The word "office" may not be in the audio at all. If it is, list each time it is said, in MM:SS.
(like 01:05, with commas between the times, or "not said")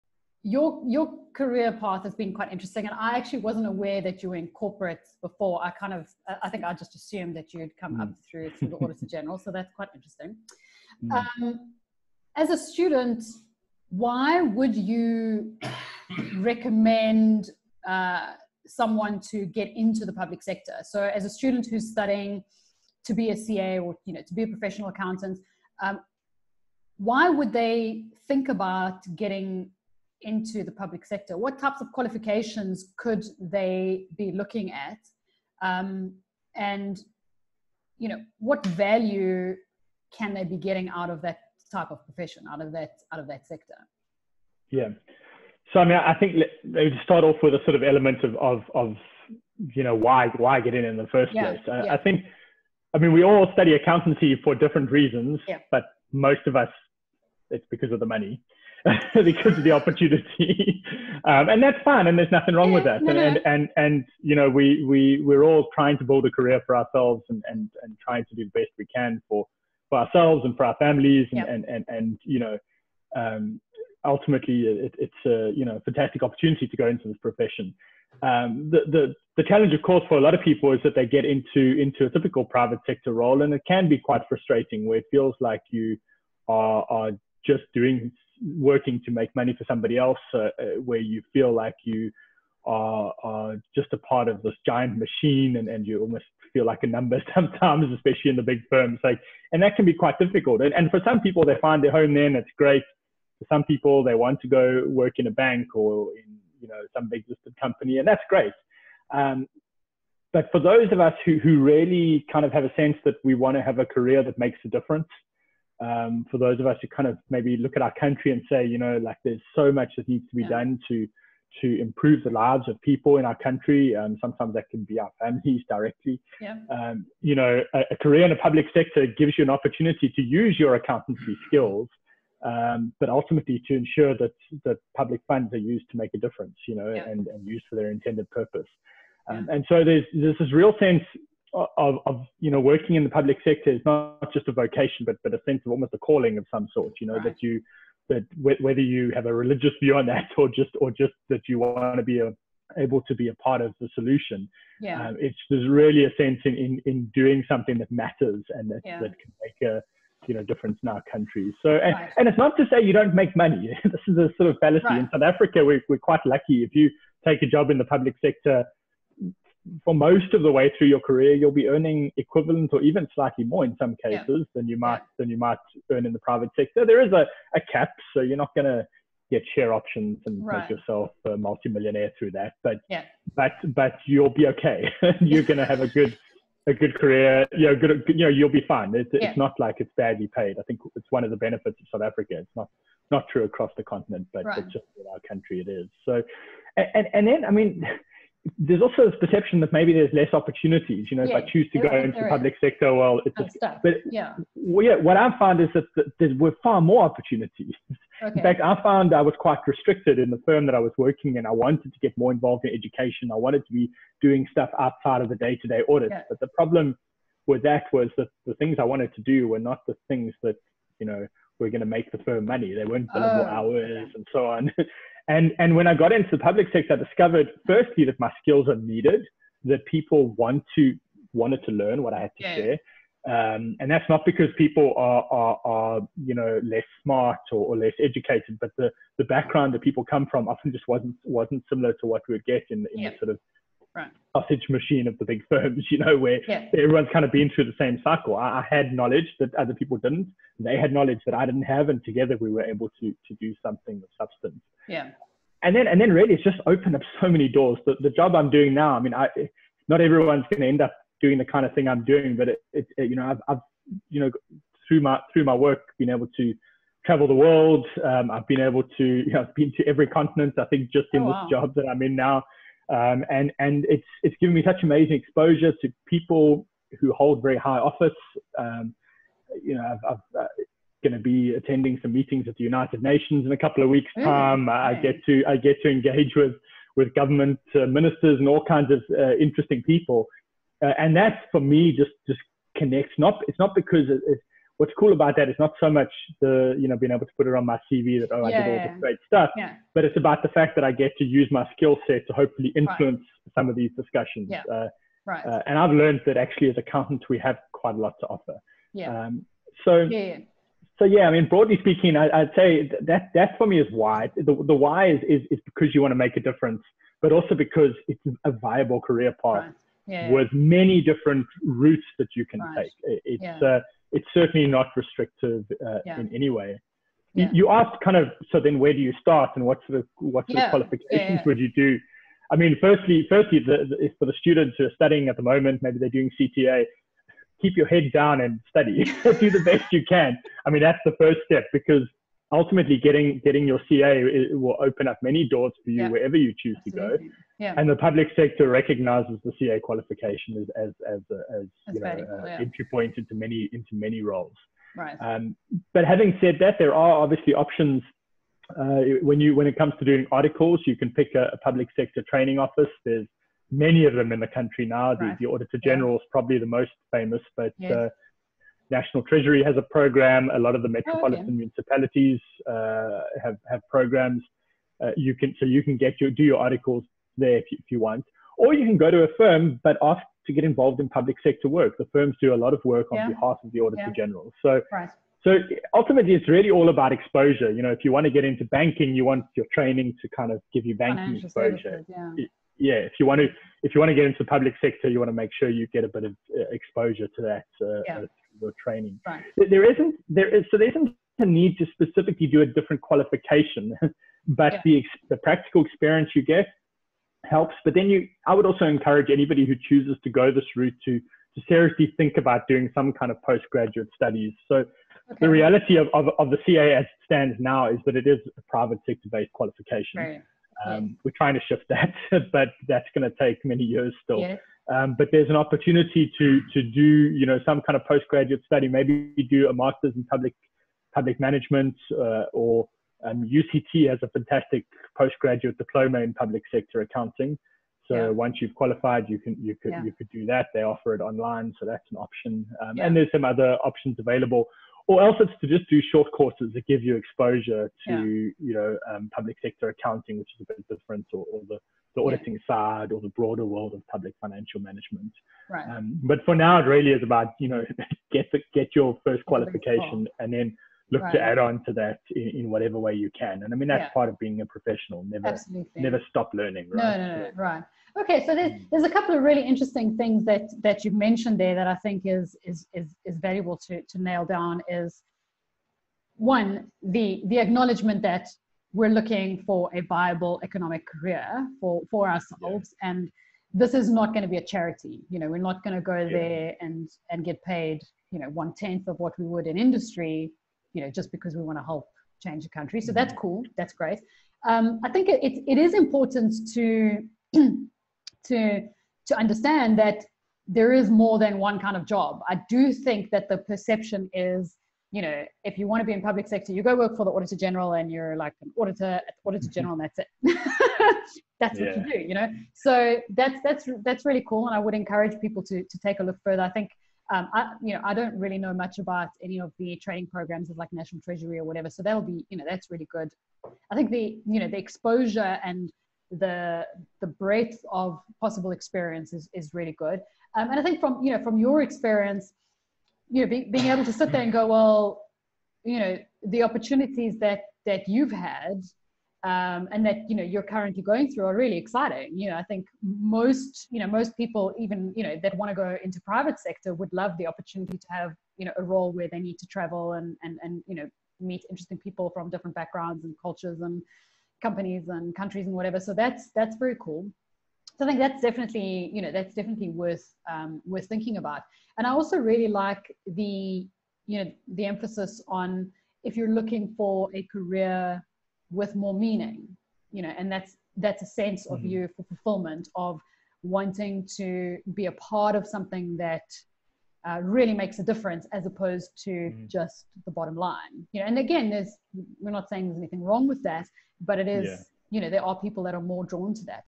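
04:37, 06:02.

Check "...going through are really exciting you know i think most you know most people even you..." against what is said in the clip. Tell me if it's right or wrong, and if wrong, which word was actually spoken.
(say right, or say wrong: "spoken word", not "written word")
right.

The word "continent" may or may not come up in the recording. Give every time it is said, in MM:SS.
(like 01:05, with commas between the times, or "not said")
03:13, 04:30.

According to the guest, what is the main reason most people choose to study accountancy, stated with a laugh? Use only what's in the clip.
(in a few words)
The money.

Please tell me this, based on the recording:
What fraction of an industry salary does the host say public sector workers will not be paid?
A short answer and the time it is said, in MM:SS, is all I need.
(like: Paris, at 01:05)
One tenth, at 08:08.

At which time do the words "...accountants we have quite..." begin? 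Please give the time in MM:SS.
05:06.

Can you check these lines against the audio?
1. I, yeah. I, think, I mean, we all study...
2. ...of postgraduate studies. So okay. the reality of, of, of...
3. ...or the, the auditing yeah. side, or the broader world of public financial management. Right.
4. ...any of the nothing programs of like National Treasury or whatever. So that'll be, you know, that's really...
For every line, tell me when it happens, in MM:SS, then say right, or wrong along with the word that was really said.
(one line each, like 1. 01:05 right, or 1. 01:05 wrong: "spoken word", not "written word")
1. 00:51 right
2. 06:53 right
3. 07:31 right
4. 08:39 wrong: "training", not "nothing".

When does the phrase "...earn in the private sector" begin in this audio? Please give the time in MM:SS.
02:55.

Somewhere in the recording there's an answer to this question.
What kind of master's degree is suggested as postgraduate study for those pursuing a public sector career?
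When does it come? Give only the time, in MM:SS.
07:11.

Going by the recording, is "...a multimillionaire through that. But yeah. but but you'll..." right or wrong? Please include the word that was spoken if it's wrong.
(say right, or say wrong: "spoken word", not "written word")
right.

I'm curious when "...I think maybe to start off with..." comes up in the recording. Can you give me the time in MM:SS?
00:45.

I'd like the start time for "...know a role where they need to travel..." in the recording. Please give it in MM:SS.
09:08.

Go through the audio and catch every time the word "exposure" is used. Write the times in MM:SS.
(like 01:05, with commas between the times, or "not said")
04:35, 06:27, 06:31, 06:36, 07:27, 08:44.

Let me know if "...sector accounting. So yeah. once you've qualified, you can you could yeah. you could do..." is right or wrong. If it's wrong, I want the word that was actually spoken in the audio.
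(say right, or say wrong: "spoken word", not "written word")
right.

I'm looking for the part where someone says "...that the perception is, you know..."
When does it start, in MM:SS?
08:23.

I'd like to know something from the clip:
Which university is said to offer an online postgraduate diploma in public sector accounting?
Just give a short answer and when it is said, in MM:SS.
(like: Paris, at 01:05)
UCT, at 07:13.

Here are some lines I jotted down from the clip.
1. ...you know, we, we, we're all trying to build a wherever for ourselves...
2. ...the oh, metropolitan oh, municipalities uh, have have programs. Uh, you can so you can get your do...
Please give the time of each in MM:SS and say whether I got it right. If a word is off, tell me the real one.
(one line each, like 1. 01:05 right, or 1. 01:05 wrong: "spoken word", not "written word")
1. 01:04 wrong: "career", not "wherever"
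2. 06:10 right.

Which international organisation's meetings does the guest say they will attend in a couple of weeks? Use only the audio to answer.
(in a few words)
United Nations.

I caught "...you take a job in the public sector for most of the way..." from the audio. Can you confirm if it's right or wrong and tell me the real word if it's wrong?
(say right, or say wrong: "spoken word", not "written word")
right.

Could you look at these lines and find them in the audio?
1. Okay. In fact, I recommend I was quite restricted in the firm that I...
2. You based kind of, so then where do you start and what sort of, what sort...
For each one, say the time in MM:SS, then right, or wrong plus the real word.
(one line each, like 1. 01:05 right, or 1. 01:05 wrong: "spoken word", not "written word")
1. 03:28 wrong: "found", not "recommend"
2. 05:27 wrong: "asked", not "based".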